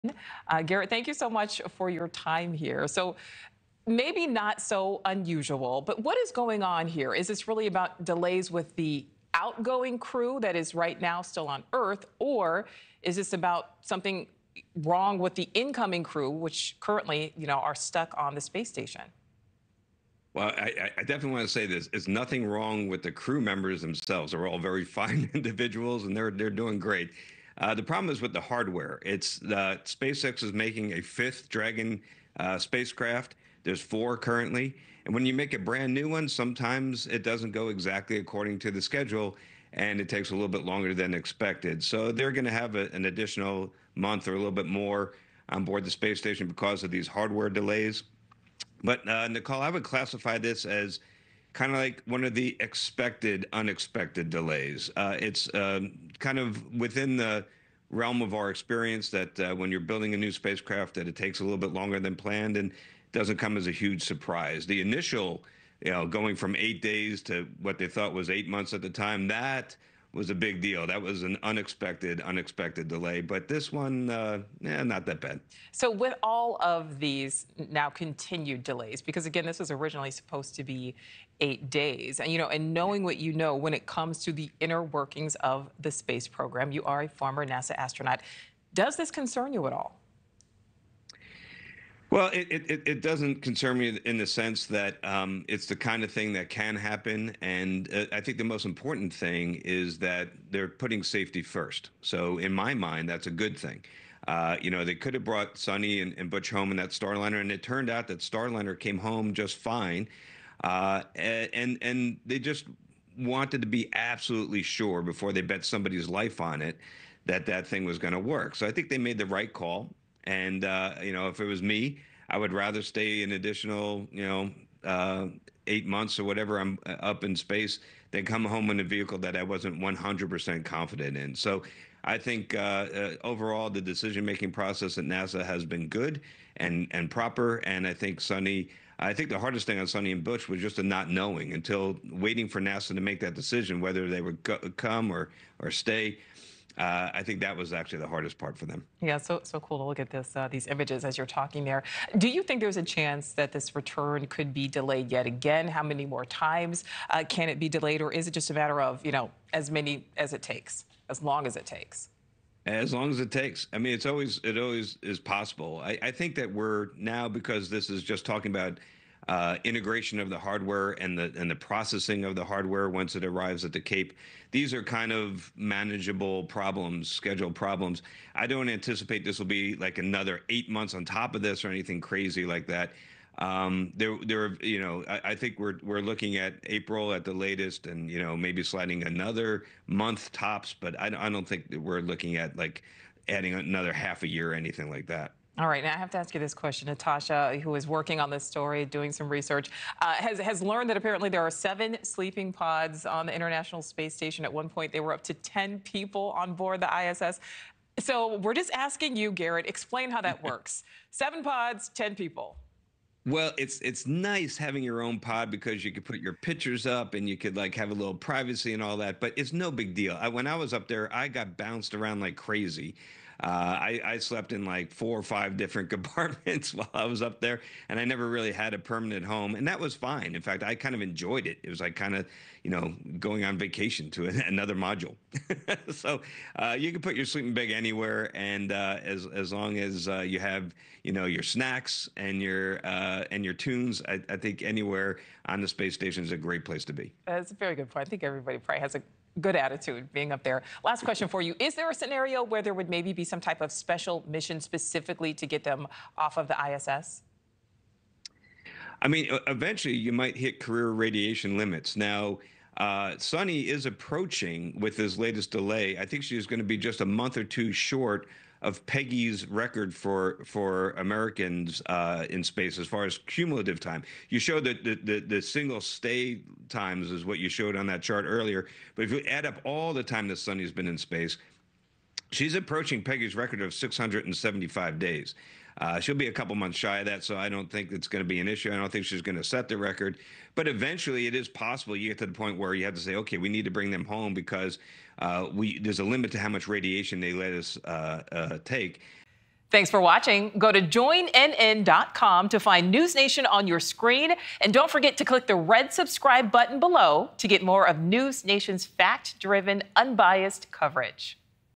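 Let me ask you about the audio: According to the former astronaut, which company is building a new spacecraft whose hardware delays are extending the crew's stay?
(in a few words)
SpaceX.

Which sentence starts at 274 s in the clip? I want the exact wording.
You showed that the, the, the single stay times is what you showed on that chart earlier.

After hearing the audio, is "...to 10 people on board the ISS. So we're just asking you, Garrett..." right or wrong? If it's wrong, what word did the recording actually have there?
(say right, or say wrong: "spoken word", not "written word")
right.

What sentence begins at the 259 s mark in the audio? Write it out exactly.
I mean, eventually you might hit career radiation limits.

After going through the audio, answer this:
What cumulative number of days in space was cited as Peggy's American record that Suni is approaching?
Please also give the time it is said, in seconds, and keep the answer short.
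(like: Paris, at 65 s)
675 days, at 283 s.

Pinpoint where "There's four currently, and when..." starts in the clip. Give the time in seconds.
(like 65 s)
33 s.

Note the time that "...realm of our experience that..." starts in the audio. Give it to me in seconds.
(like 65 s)
57 s.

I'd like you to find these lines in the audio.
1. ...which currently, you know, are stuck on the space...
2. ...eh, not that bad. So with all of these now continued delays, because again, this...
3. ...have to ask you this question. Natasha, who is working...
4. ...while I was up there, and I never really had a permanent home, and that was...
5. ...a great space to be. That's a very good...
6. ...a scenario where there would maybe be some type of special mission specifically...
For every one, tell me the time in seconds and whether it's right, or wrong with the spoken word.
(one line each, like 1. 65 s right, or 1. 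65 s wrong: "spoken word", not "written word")
1. 16 s right
2. 74 s right
3. 195 s right
4. 226 s right
5. 246 s wrong: "place", not "space"
6. 251 s right.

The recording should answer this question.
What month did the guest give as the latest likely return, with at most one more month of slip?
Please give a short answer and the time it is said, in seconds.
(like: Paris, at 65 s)
April, at 186 s.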